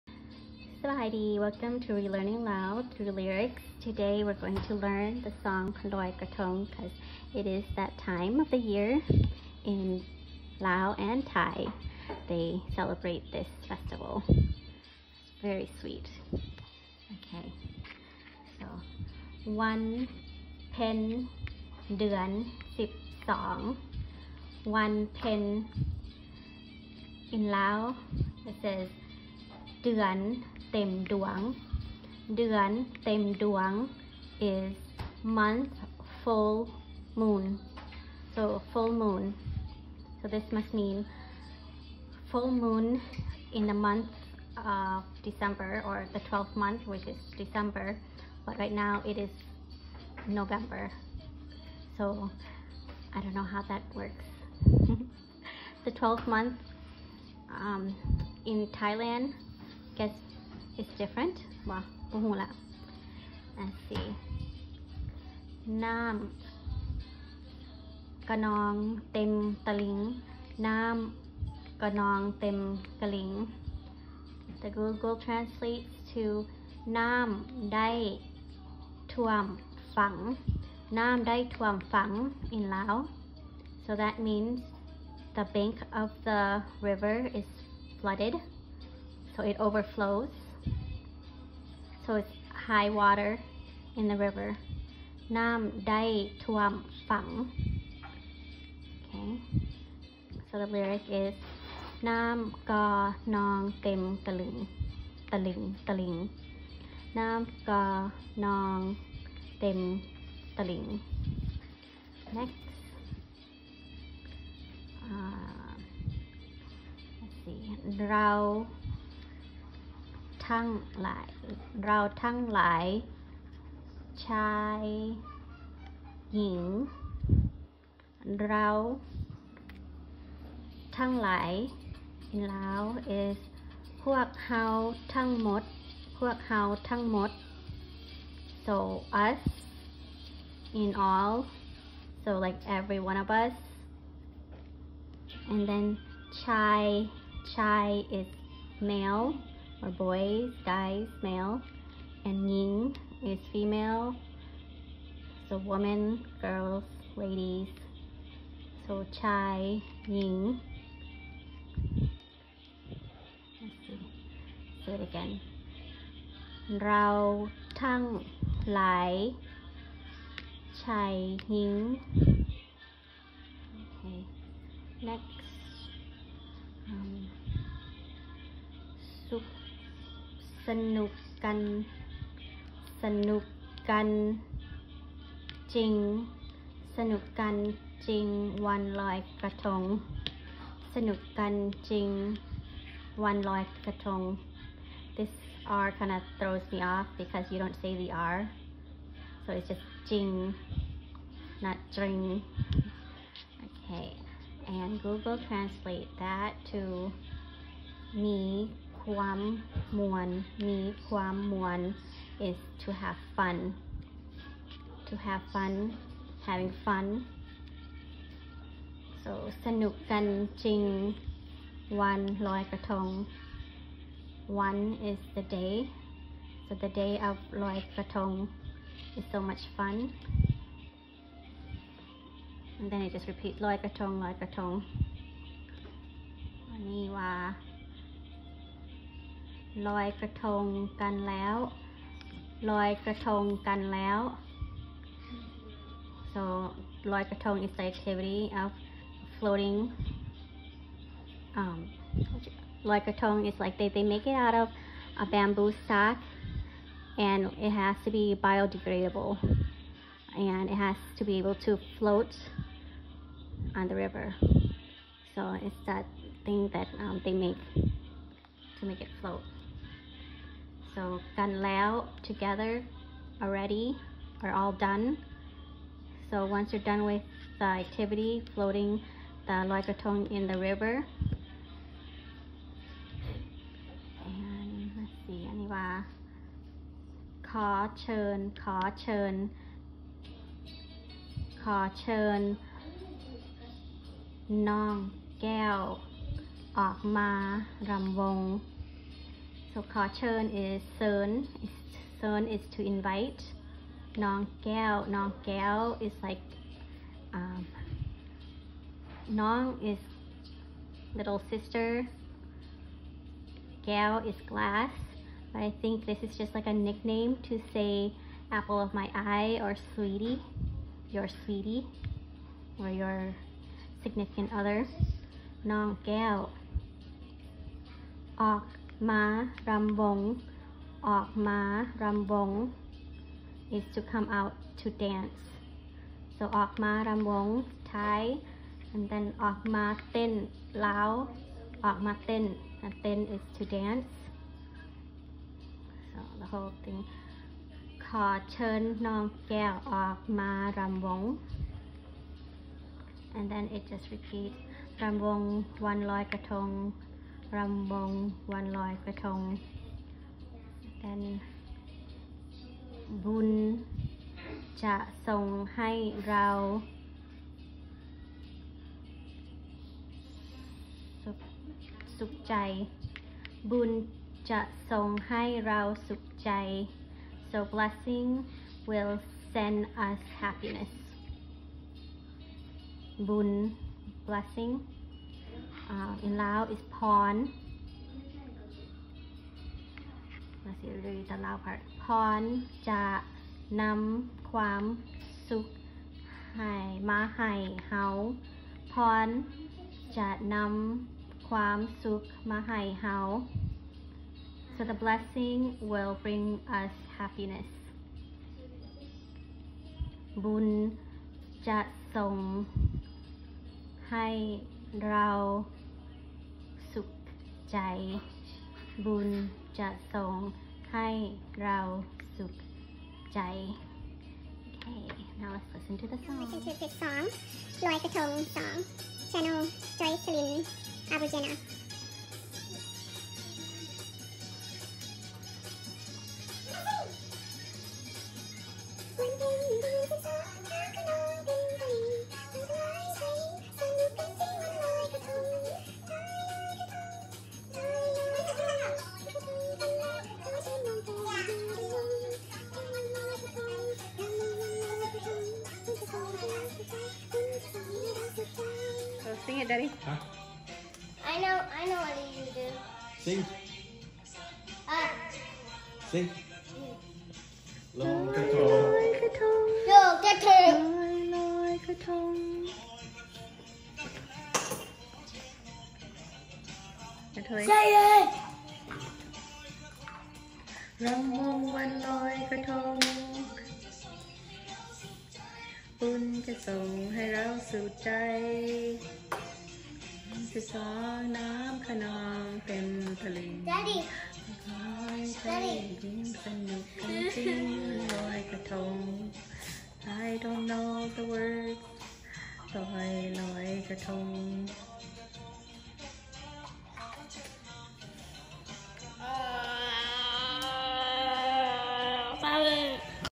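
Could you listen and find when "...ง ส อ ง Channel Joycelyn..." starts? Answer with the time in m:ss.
7:08.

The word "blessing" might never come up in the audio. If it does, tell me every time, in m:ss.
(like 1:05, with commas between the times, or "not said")
6:17, 6:24, 6:45.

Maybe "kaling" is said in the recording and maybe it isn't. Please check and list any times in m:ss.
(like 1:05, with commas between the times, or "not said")
1:13.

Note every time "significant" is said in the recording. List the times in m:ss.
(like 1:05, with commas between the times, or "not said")
5:24.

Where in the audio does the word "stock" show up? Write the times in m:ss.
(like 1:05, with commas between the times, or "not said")
4:15.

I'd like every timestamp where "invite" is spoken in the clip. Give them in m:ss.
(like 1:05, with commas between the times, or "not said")
5:02.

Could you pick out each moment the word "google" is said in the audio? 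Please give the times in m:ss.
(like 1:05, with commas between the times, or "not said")
1:14, 3:25.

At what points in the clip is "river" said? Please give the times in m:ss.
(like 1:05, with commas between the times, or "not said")
1:26, 1:34, 4:24, 4:40.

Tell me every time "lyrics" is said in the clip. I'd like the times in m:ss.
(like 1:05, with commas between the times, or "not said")
0:03, 1:40.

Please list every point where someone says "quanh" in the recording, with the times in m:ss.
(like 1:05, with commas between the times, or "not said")
8:01.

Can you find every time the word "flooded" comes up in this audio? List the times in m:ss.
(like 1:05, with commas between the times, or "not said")
1:28.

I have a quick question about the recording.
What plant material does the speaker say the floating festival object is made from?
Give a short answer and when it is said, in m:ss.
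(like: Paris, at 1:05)
bamboo, at 4:15.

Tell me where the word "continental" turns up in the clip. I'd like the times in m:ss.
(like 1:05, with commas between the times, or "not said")
not said.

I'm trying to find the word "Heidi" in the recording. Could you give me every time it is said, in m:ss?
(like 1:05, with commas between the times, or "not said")
0:00.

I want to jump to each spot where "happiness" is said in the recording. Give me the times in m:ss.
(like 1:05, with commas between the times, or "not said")
6:20, 6:47.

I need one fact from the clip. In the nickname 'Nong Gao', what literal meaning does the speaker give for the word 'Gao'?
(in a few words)
glass.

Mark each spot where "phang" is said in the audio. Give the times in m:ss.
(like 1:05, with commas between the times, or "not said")
1:37.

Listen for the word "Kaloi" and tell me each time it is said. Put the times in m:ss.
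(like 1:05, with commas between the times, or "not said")
0:05.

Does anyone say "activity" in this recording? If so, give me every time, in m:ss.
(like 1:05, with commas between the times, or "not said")
4:07, 4:37.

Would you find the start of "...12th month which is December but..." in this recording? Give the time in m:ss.
0:46.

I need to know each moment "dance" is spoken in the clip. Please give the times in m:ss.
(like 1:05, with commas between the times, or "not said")
5:35, 5:43.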